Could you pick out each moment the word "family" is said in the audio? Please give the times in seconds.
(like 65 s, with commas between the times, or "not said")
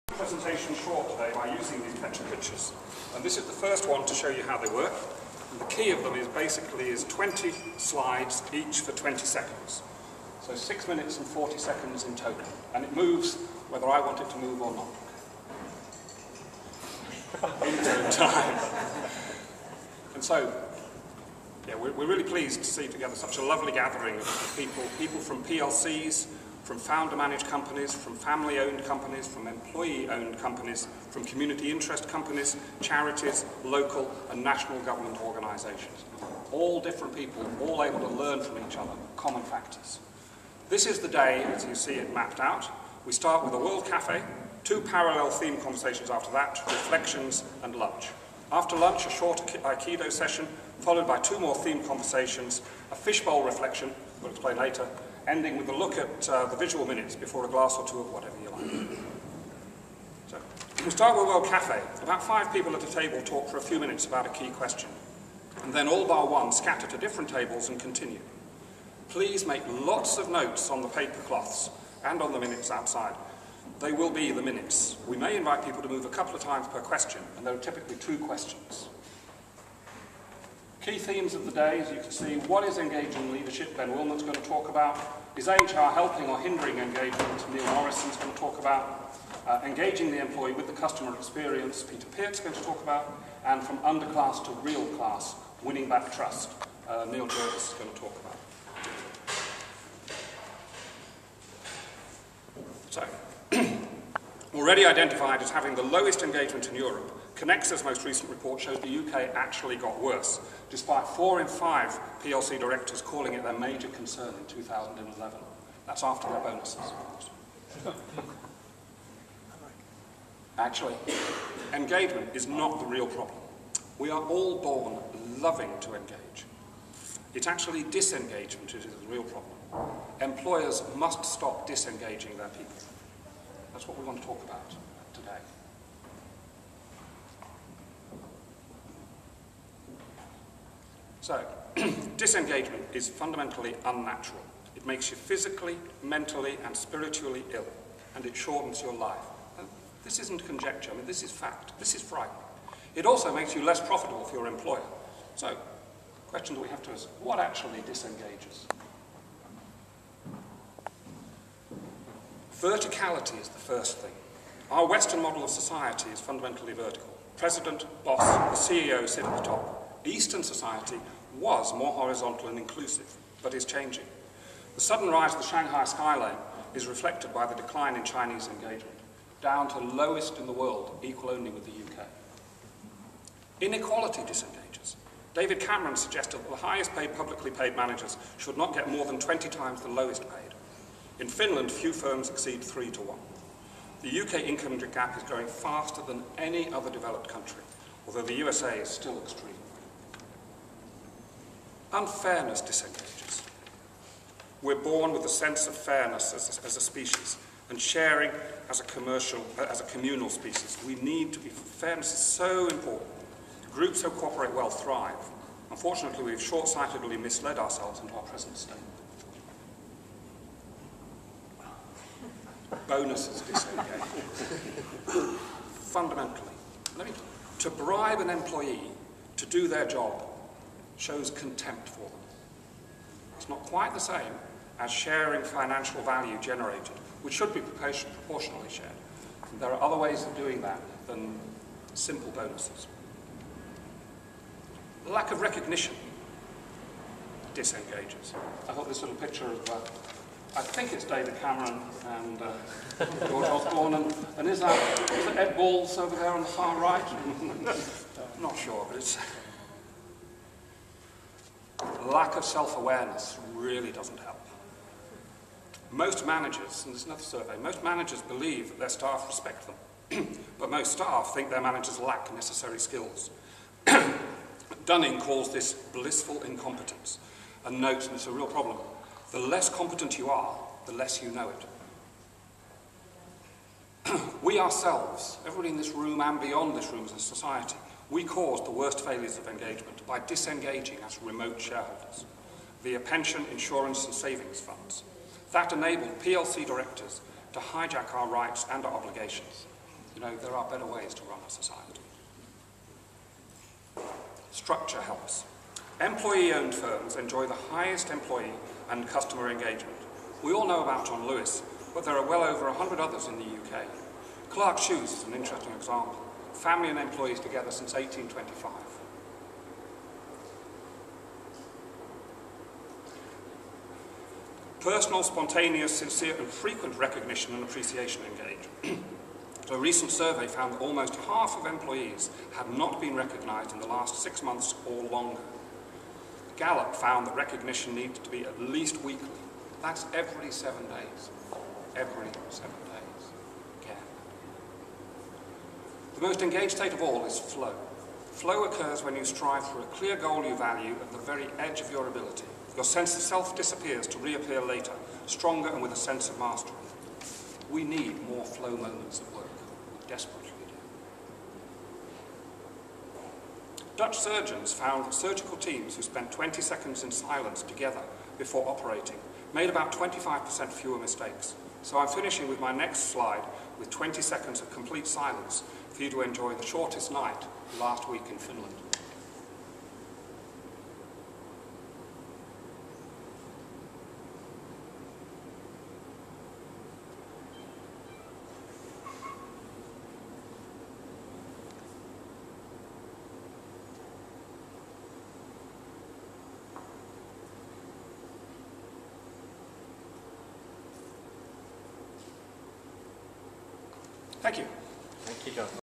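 28 s, 316 s.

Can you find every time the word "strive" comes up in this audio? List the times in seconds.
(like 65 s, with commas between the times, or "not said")
349 s.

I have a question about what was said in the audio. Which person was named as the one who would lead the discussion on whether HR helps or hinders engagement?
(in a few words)
Neil Morrison.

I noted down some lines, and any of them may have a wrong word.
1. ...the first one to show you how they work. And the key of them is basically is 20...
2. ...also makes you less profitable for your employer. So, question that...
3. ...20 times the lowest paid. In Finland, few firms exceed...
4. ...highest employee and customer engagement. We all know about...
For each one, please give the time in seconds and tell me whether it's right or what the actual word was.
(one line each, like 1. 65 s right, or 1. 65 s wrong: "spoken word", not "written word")
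1. 3 s right
2. 153 s right
3. 189 s right
4. 307 s right.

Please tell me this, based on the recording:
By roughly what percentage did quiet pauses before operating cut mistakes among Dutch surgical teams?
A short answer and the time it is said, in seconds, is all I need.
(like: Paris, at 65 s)
25%, at 369 s.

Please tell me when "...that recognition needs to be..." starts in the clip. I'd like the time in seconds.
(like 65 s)
337 s.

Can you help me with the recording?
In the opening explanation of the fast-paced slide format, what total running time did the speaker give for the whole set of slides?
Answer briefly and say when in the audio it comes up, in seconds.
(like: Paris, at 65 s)
6 minutes and 40 seconds, at 10 s.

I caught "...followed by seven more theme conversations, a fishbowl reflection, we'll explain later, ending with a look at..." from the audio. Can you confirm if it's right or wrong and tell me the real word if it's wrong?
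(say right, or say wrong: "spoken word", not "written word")
wrong: "two", not "seven".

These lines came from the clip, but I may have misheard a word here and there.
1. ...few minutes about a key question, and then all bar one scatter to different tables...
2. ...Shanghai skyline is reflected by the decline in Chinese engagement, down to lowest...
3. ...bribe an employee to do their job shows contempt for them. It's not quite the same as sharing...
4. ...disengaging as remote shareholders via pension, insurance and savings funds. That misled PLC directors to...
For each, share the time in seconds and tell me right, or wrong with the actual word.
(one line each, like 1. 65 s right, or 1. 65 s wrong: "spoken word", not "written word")
1. 63 s right
2. 175 s right
3. 227 s right
4. 290 s wrong: "enabled", not "misled".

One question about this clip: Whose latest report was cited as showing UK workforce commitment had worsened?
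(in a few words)
Kenexa.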